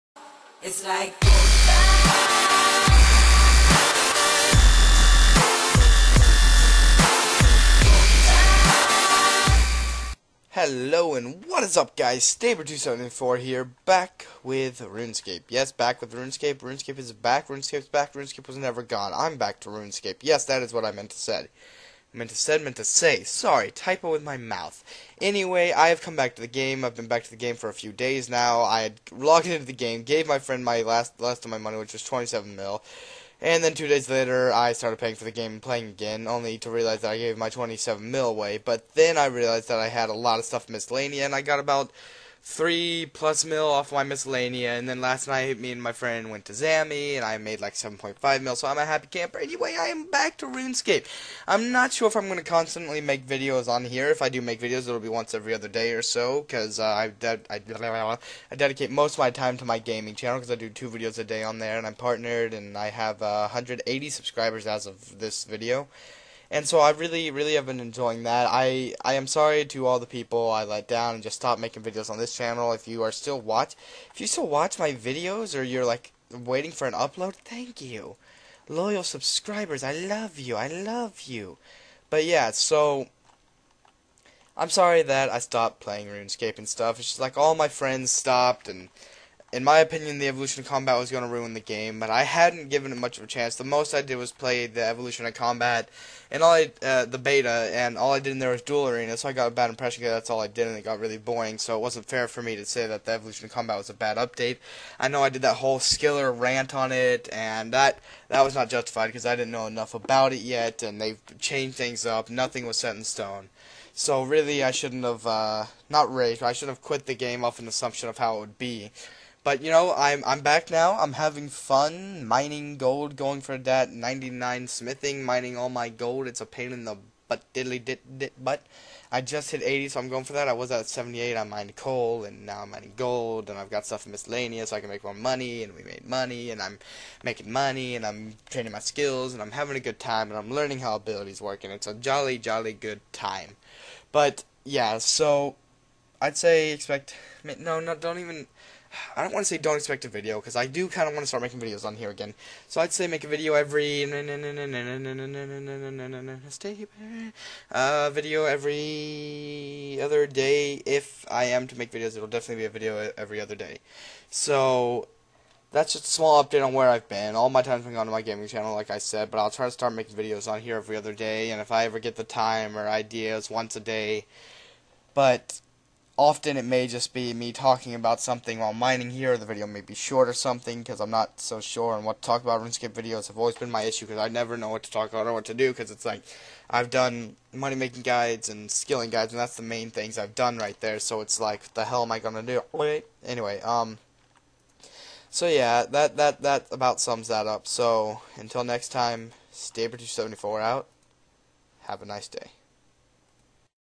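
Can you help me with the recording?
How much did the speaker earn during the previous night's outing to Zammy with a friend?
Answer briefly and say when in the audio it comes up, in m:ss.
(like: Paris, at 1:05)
7.5 mil, at 0:47.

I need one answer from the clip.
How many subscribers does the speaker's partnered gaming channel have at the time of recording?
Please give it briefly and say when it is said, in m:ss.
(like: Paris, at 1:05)
180, at 1:03.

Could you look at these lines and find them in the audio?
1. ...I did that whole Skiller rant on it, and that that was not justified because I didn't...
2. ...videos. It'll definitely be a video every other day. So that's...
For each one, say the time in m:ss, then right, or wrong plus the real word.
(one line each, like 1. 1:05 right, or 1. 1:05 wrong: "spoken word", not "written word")
1. 1:45 right
2. 2:41 right.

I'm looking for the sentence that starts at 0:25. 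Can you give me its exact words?
Anyway, I have come back to the game.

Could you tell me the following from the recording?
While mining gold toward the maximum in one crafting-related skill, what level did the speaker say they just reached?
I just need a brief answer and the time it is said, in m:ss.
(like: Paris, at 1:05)
80, at 2:09.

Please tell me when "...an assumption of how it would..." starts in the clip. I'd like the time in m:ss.
1:57.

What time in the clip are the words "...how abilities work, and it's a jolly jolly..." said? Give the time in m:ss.
2:20.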